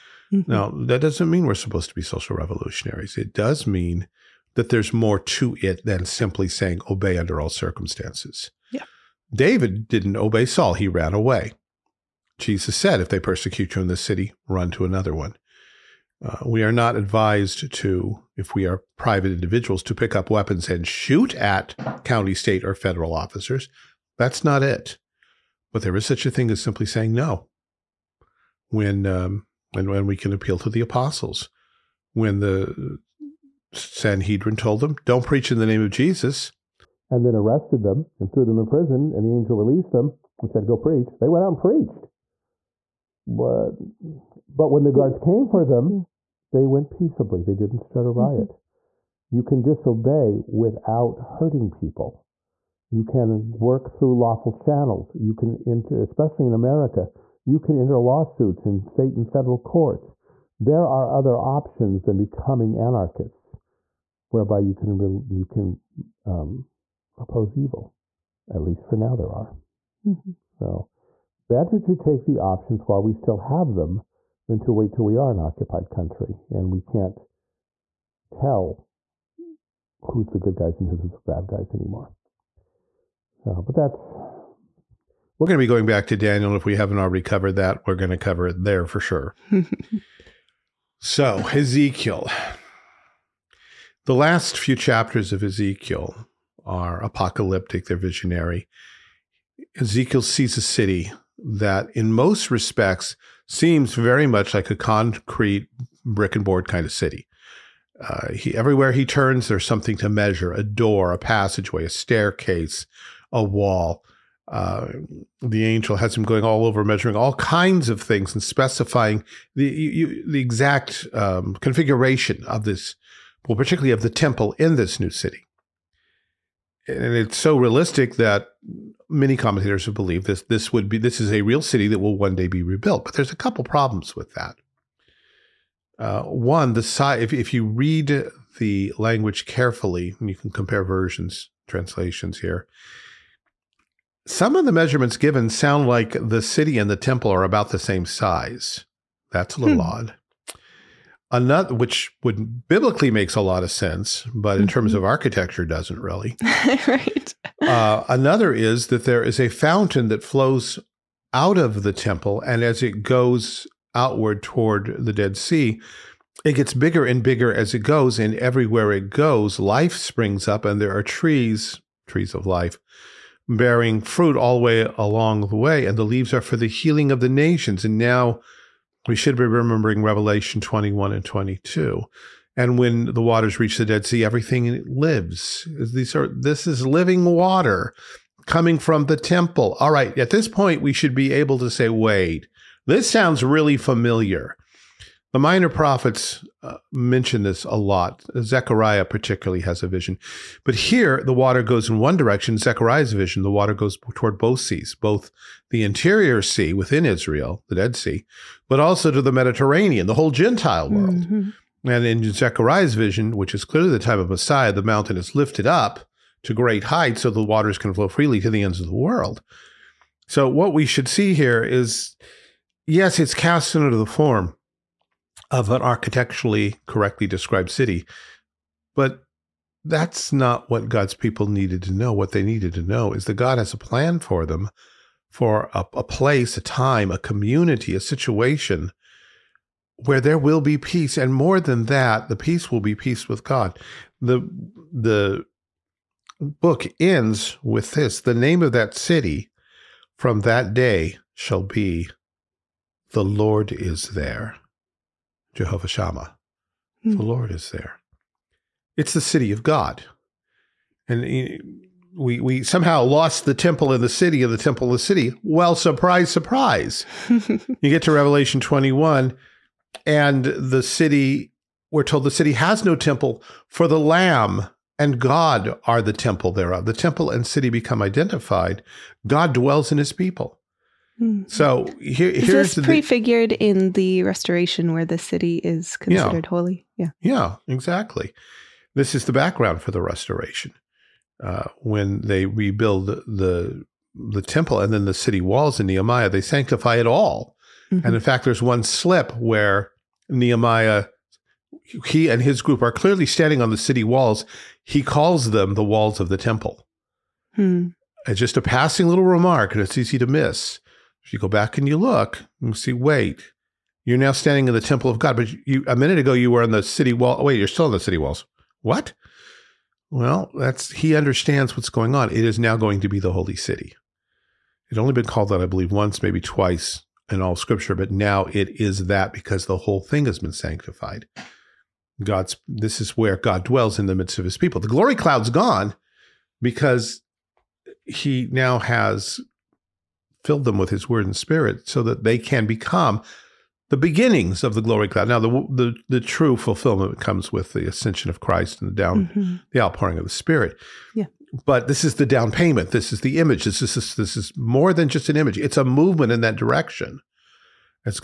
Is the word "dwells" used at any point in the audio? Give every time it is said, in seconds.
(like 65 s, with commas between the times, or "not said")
279 s, 333 s.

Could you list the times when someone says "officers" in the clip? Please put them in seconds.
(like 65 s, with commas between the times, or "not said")
23 s.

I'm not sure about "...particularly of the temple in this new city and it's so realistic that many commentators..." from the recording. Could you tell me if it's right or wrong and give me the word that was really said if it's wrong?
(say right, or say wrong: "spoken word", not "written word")
right.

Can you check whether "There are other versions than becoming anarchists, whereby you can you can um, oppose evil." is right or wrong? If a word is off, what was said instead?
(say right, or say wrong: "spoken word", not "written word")
wrong: "options", not "versions".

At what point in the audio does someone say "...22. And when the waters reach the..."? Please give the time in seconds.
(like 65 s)
181 s.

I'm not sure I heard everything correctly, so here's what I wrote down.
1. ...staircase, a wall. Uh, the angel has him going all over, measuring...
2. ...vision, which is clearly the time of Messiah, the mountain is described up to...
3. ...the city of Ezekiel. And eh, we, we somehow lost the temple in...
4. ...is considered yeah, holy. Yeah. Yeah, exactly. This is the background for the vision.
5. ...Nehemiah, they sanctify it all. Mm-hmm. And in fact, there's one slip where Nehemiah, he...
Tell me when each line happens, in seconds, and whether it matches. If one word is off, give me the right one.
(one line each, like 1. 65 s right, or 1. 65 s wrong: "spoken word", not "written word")
1. 111 s right
2. 212 s wrong: "lifted", not "described"
3. 259 s wrong: "God", not "Ezekiel"
4. 285 s wrong: "restoration", not "vision"
5. 295 s right.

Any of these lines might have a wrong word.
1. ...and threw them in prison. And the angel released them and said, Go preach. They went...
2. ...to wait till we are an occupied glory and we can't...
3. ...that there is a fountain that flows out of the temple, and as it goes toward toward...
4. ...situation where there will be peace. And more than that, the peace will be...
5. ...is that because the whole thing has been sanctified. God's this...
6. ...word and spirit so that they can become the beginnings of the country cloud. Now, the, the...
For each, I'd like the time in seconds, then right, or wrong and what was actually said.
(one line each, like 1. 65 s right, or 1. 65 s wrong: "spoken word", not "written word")
1. 38 s right
2. 74 s wrong: "country", not "glory"
3. 158 s wrong: "outward", not "toward"
4. 237 s right
5. 328 s right
6. 341 s wrong: "glory", not "country".